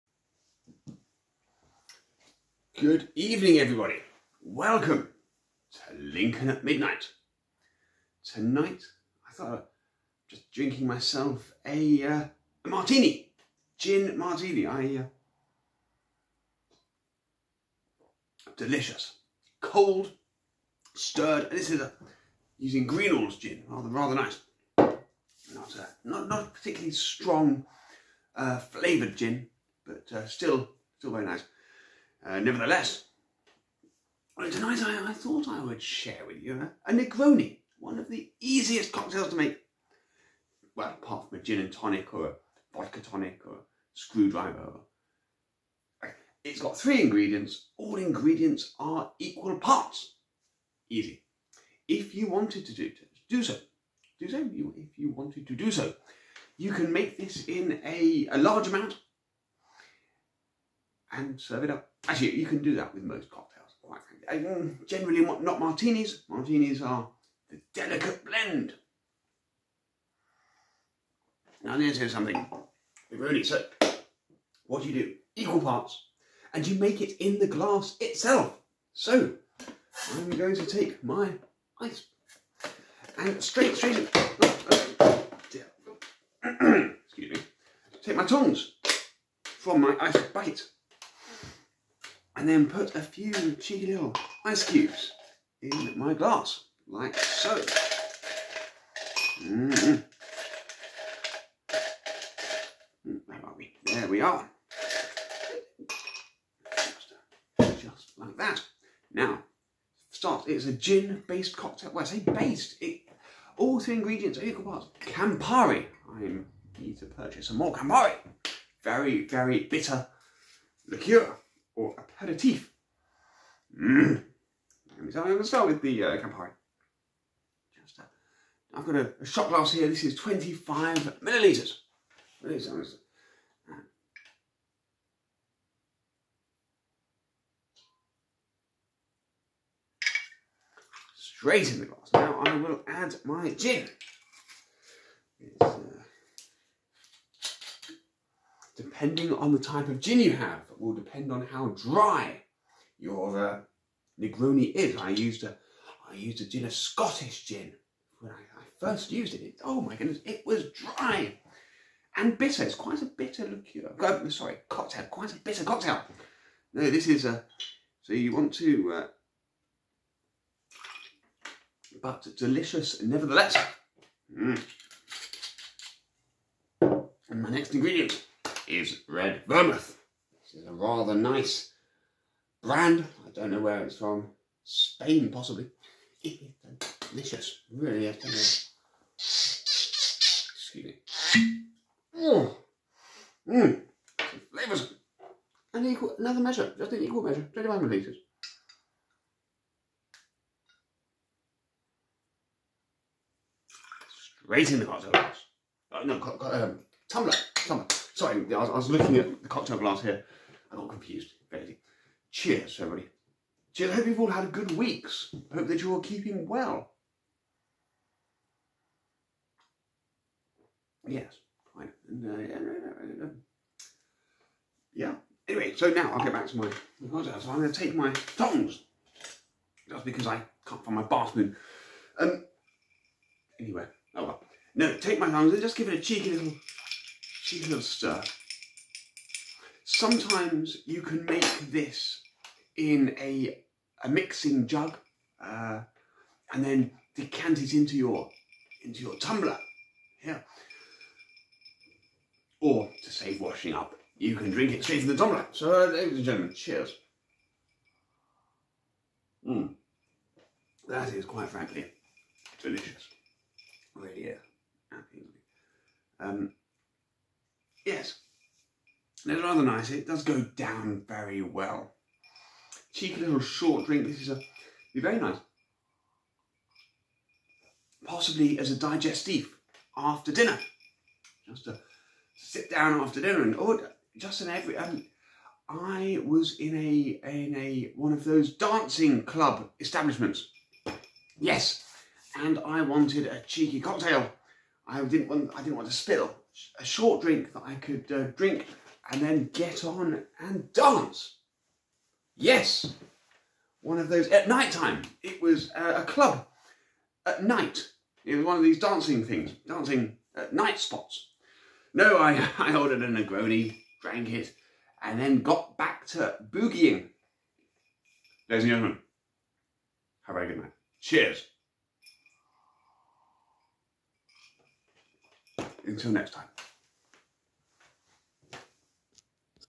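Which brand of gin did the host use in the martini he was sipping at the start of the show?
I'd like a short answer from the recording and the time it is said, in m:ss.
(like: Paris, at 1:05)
Greenall's, at 0:22.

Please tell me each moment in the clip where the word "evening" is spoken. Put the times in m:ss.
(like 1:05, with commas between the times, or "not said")
0:03.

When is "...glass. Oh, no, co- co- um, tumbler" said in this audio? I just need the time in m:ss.
3:25.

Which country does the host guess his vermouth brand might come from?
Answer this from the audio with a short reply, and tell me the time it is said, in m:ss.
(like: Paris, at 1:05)
Spain, at 3:04.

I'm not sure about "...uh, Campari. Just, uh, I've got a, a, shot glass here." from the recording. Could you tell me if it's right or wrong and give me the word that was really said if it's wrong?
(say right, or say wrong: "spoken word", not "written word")
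right.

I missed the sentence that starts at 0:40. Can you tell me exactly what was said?
Well, apart from a gin and tonic or a vodka tonic or a screwdriver.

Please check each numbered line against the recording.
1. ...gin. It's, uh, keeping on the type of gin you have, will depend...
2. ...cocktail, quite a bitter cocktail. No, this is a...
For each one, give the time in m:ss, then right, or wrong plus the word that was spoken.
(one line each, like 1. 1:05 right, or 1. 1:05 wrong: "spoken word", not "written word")
1. 2:23 wrong: "depending", not "keeping"
2. 2:44 right.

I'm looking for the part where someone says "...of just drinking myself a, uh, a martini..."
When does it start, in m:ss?
0:09.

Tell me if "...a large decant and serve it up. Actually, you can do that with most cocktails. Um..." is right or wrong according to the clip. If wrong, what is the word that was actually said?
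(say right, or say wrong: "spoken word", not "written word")
wrong: "amount", not "decant".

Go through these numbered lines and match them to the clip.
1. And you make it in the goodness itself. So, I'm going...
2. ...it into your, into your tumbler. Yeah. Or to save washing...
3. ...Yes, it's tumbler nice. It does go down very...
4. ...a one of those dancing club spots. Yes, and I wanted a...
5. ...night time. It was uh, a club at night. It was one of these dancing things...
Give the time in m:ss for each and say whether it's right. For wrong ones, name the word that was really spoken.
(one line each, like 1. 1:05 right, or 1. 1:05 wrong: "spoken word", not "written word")
1. 1:16 wrong: "glass", not "goodness"
2. 4:07 right
3. 4:27 wrong: "rather", not "tumbler"
4. 4:47 wrong: "establishments", not "spots"
5. 5:04 right.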